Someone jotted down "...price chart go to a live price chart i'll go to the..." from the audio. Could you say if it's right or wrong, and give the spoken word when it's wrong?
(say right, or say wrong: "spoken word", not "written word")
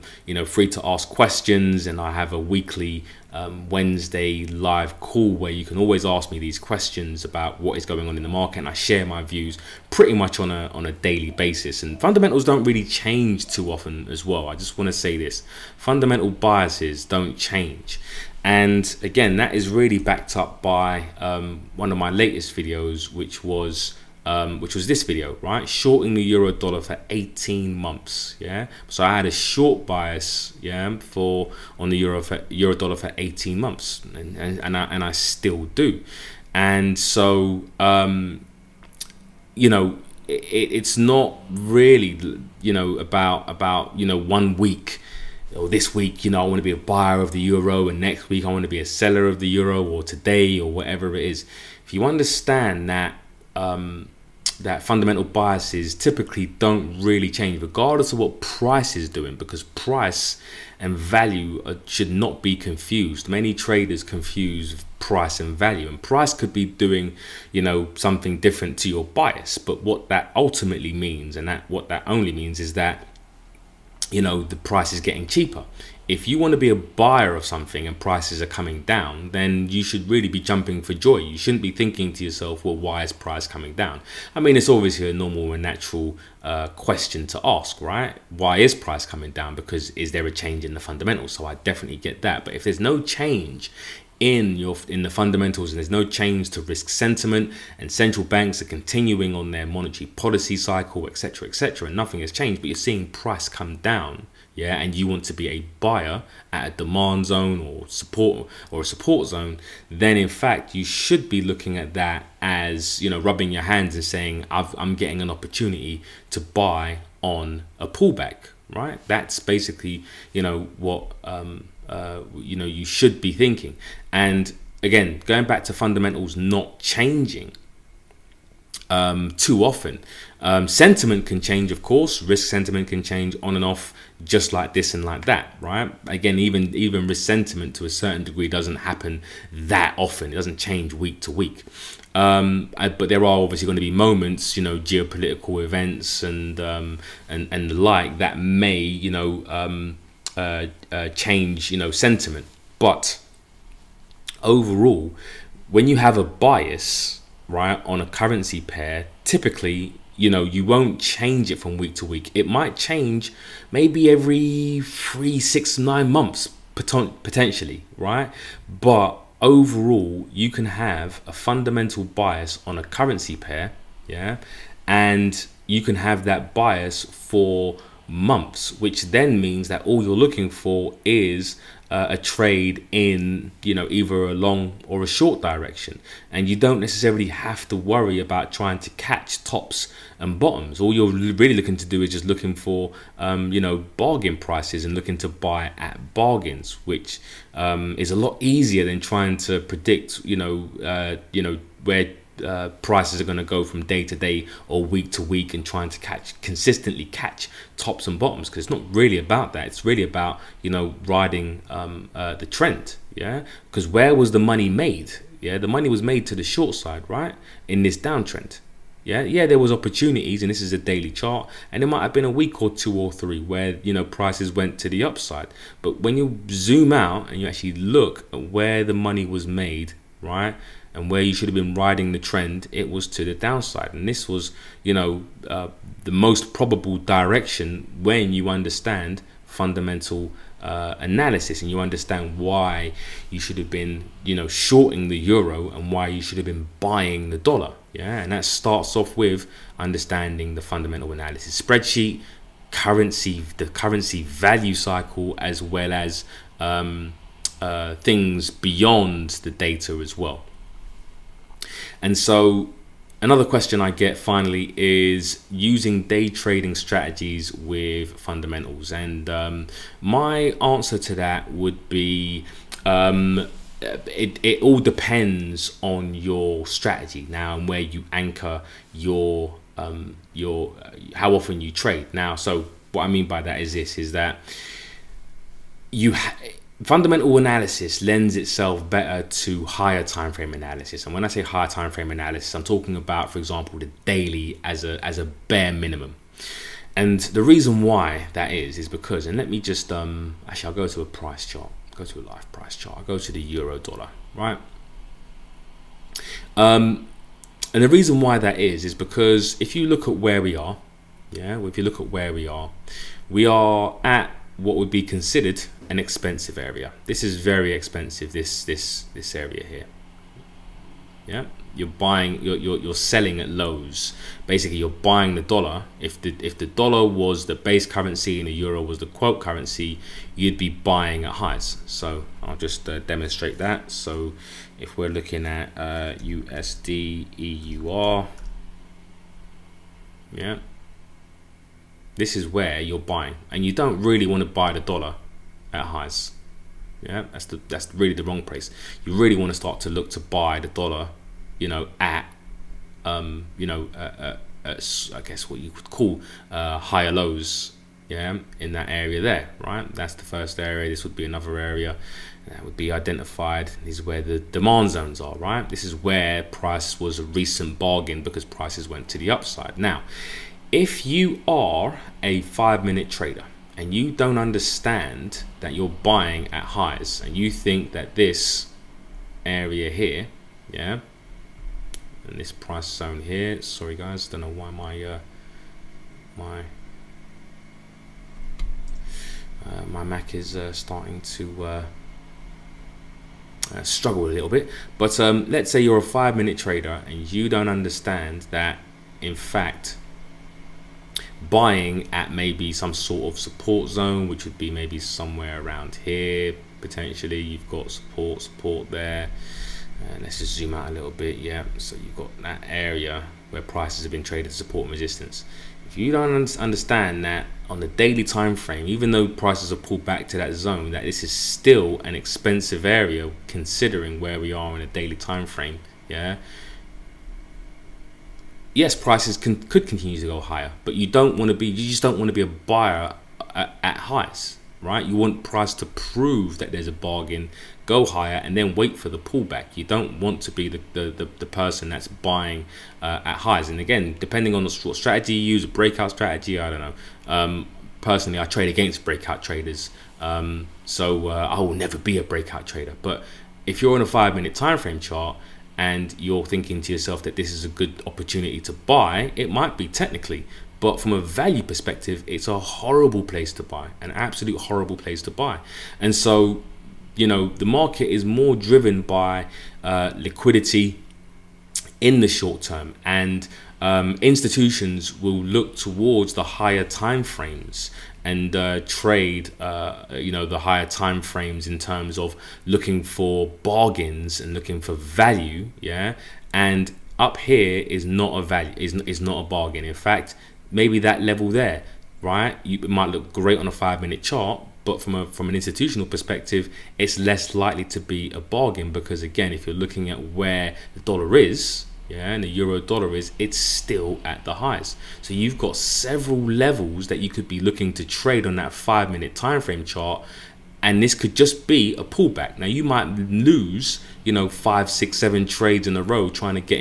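right.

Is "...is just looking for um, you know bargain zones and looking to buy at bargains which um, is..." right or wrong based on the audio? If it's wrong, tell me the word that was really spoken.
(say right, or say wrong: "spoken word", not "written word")
wrong: "prices", not "zones".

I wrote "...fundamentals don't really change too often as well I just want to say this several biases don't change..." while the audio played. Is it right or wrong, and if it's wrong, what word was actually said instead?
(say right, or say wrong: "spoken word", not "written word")
wrong: "fundamental", not "several".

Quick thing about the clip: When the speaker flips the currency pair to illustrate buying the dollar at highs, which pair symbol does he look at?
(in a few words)
USD EUR.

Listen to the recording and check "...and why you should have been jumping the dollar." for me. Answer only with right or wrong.
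wrong.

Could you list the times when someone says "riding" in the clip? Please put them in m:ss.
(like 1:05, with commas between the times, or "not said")
3:31, 3:51.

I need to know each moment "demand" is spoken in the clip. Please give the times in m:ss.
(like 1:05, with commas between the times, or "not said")
1:46, 6:04.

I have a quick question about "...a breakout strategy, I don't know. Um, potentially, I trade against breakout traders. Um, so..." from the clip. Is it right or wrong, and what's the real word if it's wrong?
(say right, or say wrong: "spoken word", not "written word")
wrong: "personally", not "potentially".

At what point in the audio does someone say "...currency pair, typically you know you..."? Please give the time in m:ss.
2:38.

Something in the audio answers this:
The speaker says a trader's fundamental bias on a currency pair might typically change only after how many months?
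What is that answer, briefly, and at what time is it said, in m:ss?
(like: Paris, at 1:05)
3, 6 or 9 months, at 2:44.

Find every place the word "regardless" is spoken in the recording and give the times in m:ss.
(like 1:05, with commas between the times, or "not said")
0:57.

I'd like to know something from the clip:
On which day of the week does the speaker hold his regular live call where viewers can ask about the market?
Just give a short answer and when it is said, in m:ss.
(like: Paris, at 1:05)
Wednesday, at 0:03.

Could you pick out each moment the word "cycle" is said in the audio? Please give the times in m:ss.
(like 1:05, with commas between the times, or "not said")
1:40, 4:14.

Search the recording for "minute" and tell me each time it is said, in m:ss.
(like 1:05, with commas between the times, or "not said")
6:12, 6:36, 7:34, 8:14, 8:29.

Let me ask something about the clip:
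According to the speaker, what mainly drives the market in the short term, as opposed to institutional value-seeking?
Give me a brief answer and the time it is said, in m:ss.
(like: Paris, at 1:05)
Liquidity, at 7:50.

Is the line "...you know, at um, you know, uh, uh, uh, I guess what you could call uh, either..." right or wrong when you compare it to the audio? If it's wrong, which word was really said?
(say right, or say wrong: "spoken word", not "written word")
wrong: "higher", not "either".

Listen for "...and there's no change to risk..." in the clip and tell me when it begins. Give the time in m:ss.
1:35.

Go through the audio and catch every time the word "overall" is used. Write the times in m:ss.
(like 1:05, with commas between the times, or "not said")
2:34, 2:49.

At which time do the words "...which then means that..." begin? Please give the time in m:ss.
2:58.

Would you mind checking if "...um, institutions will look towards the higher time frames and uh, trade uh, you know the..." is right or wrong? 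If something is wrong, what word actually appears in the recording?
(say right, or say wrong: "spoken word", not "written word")
right.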